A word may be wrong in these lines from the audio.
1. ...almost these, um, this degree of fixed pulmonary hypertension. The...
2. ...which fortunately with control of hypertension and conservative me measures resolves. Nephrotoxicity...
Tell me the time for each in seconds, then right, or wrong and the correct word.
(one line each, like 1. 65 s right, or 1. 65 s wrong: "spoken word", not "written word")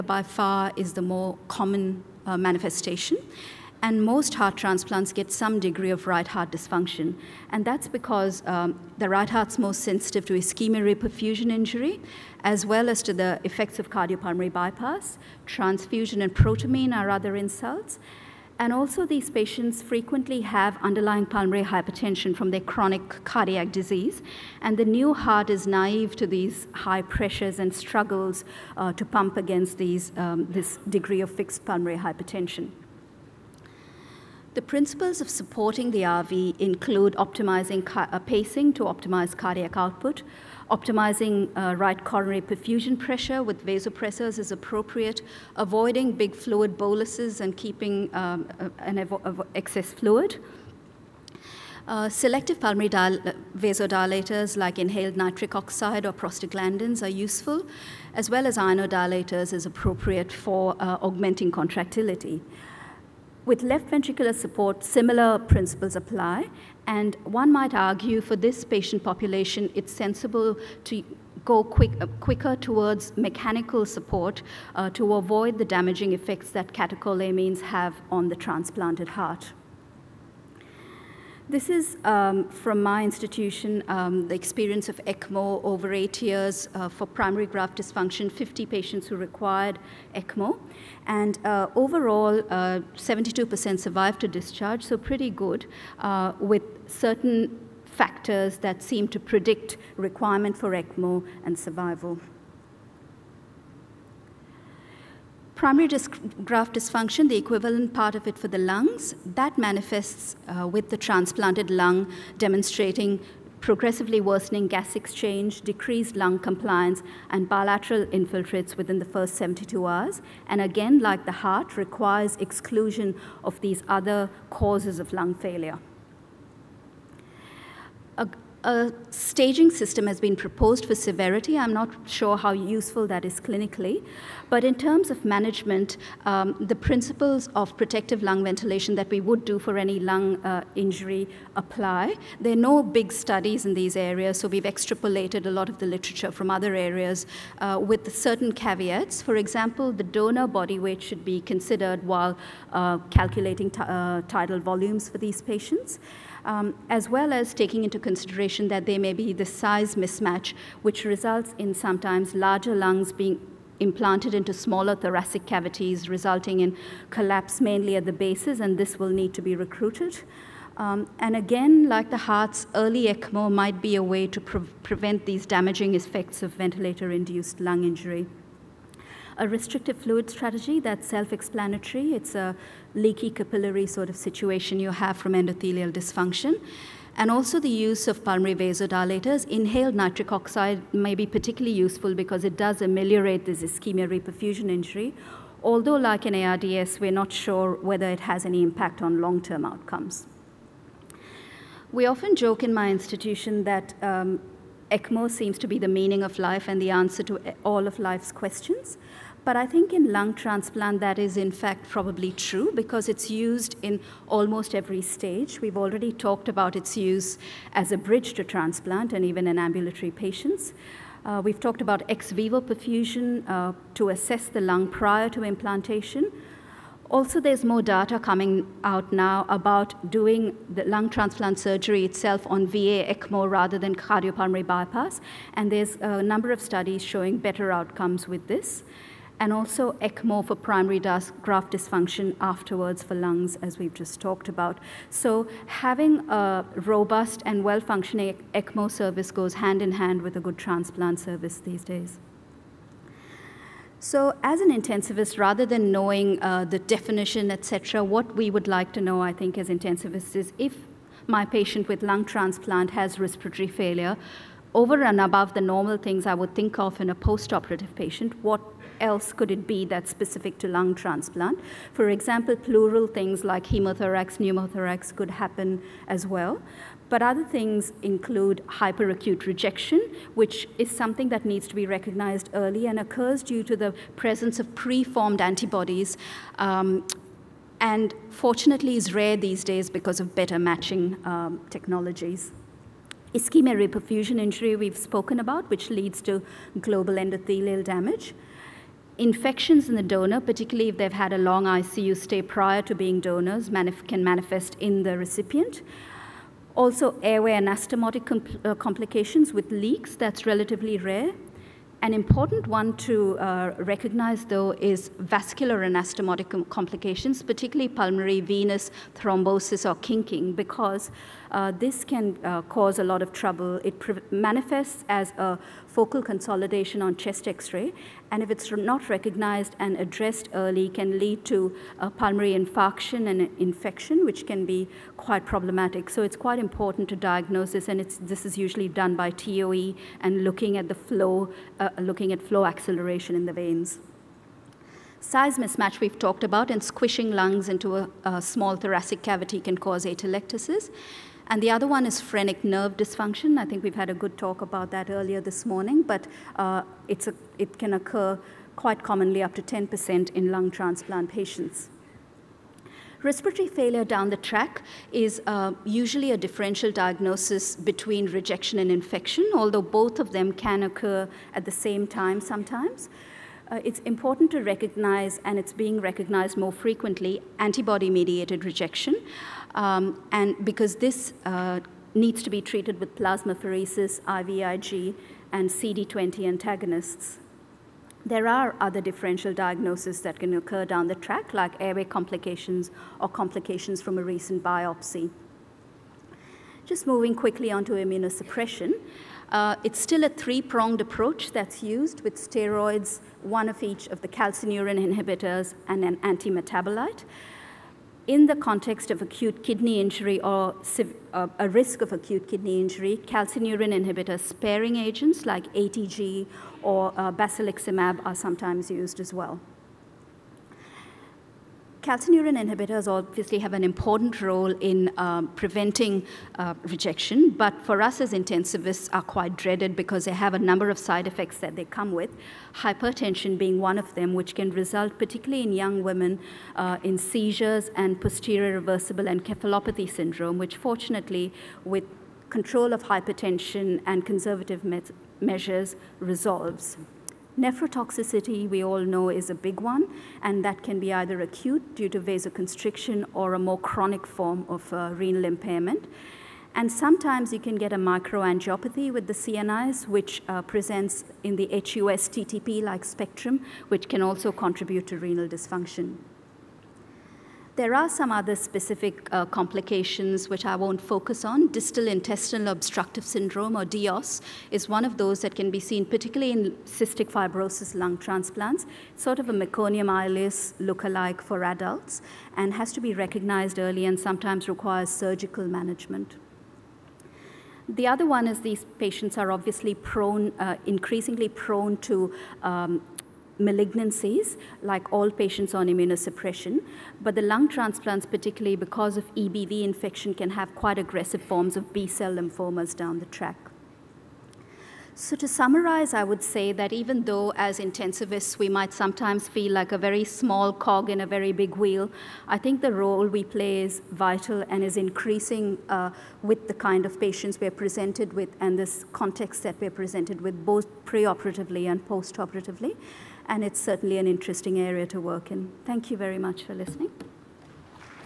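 1. 29 s wrong: "against", not "almost"
2. 440 s right.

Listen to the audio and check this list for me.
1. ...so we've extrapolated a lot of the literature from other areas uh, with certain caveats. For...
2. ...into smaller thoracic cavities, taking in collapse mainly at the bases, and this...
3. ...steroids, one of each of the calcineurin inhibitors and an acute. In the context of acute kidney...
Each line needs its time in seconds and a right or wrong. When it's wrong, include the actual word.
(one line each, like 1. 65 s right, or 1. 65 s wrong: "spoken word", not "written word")
1. 144 s right
2. 164 s wrong: "resulting", not "taking"
3. 402 s wrong: "antimetabolite", not "acute".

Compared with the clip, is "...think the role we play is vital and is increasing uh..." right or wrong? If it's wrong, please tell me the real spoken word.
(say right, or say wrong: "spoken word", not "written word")
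right.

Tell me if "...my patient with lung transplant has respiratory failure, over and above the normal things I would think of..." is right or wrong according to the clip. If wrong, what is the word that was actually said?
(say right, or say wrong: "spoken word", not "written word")
right.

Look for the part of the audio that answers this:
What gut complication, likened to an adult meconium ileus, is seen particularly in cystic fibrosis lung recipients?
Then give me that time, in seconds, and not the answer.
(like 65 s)
471 s.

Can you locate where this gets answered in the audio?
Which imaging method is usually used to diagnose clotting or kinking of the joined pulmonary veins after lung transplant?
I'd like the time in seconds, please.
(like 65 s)
339 s.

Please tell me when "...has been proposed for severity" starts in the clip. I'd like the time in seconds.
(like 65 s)
130 s.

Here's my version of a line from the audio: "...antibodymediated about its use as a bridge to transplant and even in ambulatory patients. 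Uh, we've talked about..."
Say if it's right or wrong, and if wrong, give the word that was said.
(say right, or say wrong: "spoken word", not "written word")
wrong: "talked", not "antibodymediated".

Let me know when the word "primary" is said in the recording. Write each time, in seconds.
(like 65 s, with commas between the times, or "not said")
87 s, 105 s, 240 s.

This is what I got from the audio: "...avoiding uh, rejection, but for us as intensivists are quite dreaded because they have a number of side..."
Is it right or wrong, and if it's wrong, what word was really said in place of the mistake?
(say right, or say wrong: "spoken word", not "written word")
wrong: "preventing", not "avoiding".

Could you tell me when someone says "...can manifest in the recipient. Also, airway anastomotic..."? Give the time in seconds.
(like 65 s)
304 s.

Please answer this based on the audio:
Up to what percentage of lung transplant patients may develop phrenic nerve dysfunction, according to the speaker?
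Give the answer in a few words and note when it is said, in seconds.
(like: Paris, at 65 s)
10%, at 359 s.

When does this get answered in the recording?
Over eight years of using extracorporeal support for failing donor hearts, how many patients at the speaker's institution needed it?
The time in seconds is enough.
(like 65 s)
88 s.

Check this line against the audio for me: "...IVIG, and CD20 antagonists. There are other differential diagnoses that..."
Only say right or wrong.
right.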